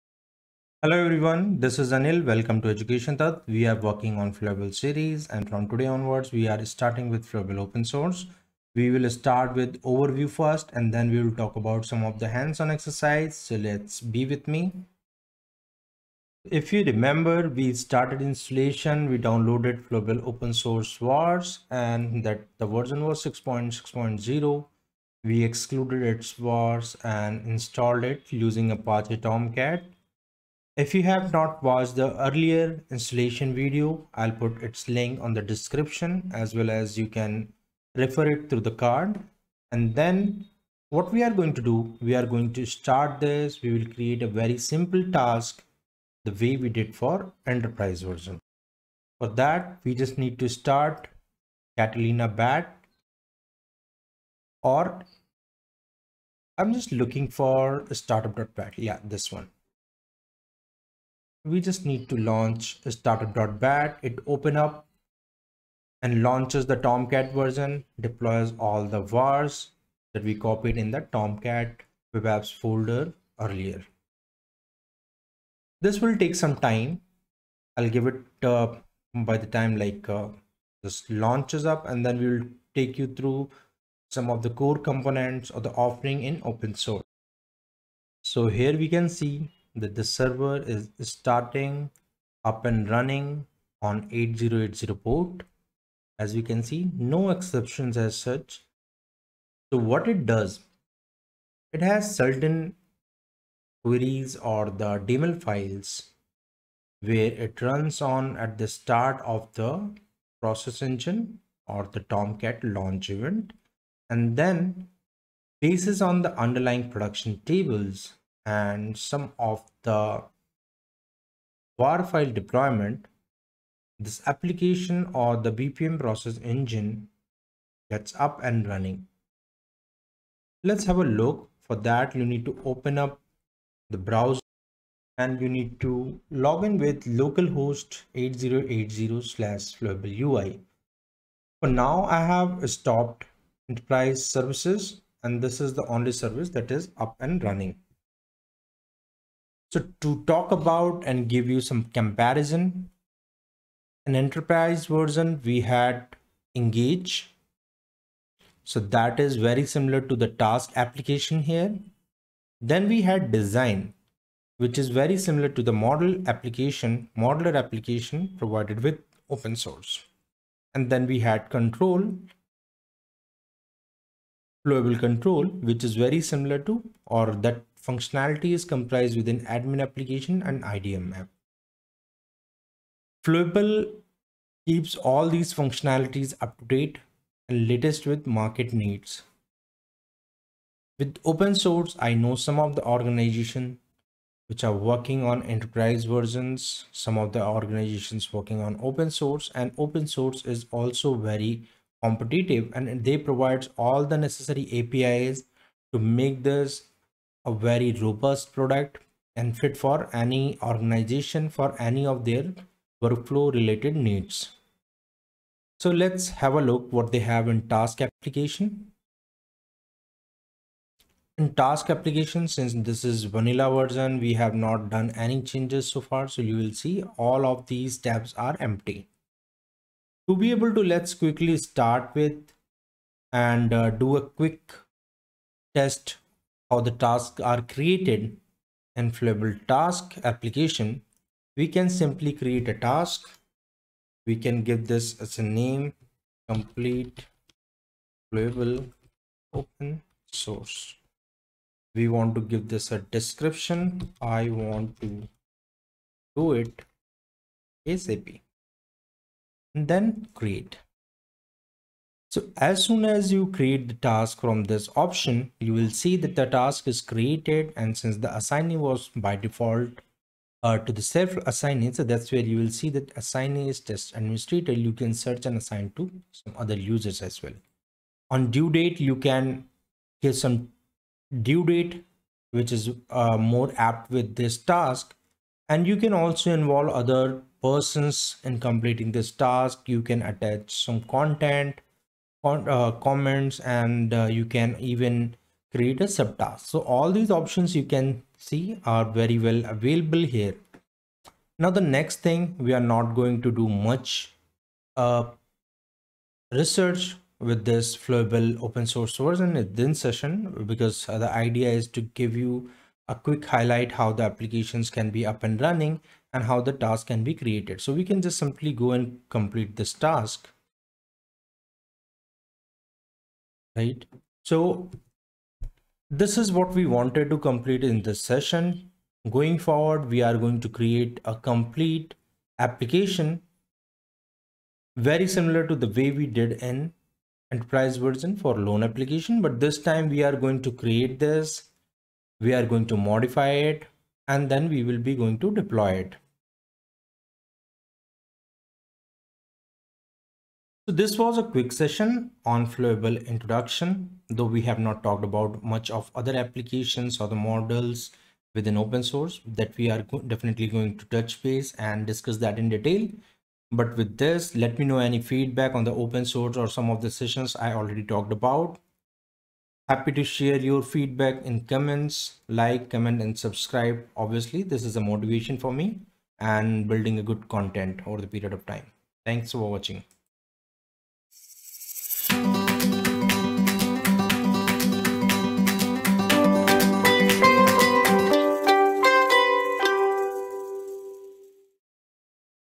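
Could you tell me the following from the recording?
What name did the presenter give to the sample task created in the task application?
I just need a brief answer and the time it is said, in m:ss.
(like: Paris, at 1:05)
Complete flowable open source, at 4:06.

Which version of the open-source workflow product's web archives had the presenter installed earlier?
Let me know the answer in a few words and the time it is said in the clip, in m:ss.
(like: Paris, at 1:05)
6.6.0, at 0:23.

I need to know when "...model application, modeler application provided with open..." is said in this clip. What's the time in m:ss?
2:45.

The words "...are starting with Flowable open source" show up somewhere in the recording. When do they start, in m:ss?
0:06.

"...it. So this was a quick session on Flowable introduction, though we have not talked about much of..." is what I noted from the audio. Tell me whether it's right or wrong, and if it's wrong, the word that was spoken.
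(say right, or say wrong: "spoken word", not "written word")
right.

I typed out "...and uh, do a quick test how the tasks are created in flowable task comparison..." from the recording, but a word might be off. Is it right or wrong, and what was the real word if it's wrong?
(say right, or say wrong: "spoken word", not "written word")
wrong: "application", not "comparison".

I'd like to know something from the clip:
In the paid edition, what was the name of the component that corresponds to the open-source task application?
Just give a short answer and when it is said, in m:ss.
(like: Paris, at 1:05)
Engage, at 2:36.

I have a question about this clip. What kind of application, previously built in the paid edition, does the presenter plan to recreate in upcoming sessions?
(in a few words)
Loan application.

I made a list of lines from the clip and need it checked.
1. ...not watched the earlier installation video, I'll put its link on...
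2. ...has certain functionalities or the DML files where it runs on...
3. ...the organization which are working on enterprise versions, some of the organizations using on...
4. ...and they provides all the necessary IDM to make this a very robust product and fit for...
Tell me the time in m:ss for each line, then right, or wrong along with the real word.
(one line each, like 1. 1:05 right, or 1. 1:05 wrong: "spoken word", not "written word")
1. 0:31 right
2. 1:41 wrong: "queries", not "functionalities"
3. 3:12 wrong: "working", not "using"
4. 3:22 wrong: "APIs", not "IDM".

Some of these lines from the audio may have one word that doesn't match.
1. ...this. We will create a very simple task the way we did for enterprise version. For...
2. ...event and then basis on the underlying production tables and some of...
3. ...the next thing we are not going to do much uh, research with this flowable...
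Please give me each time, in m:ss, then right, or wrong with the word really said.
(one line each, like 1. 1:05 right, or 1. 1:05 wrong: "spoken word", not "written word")
1. 0:43 right
2. 1:53 right
3. 5:01 right.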